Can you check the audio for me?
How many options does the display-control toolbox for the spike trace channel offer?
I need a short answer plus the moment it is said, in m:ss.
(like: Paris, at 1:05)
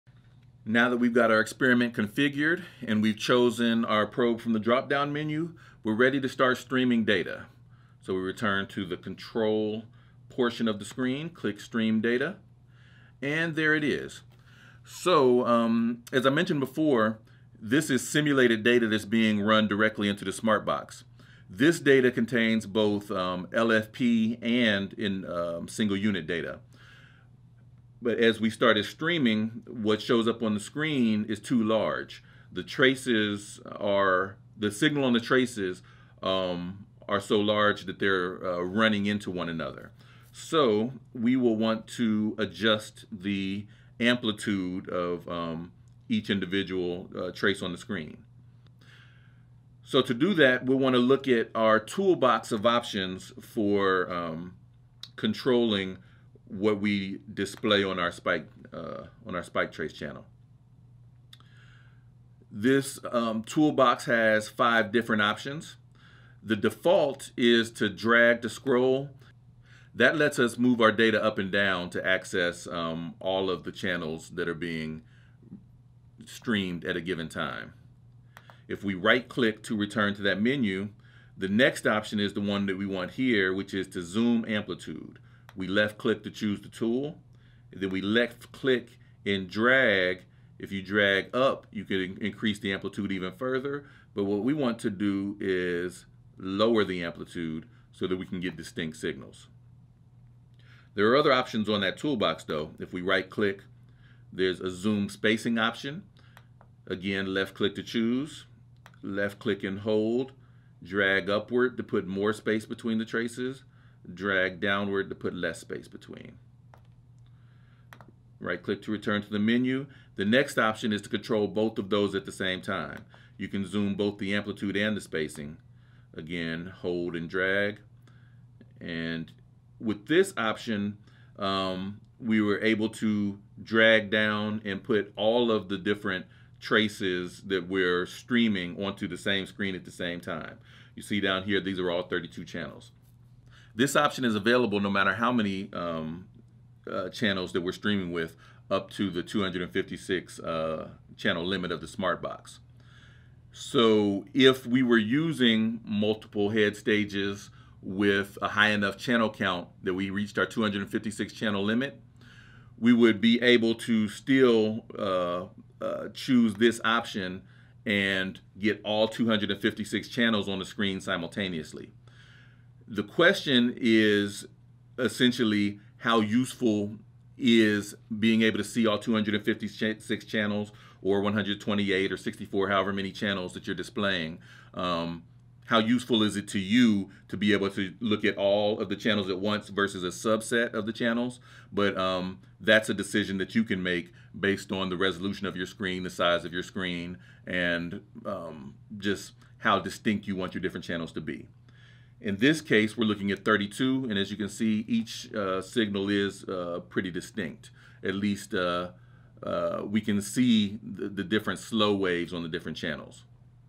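5, at 1:04.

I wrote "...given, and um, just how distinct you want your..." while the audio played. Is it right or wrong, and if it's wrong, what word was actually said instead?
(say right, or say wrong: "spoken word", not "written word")
wrong: "screen", not "given".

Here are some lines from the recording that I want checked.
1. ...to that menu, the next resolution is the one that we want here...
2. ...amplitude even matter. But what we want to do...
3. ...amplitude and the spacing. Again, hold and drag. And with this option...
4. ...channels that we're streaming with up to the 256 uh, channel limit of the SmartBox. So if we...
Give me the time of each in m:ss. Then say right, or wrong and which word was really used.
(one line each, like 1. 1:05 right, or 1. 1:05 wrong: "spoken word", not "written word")
1. 1:20 wrong: "option", not "resolution"
2. 1:32 wrong: "further", not "matter"
3. 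2:04 right
4. 2:27 right.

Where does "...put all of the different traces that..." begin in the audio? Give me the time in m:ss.
2:14.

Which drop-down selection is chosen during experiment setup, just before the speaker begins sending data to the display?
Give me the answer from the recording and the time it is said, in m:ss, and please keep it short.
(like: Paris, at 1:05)
probe, at 0:04.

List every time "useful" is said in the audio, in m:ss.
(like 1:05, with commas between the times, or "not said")
2:56, 3:05.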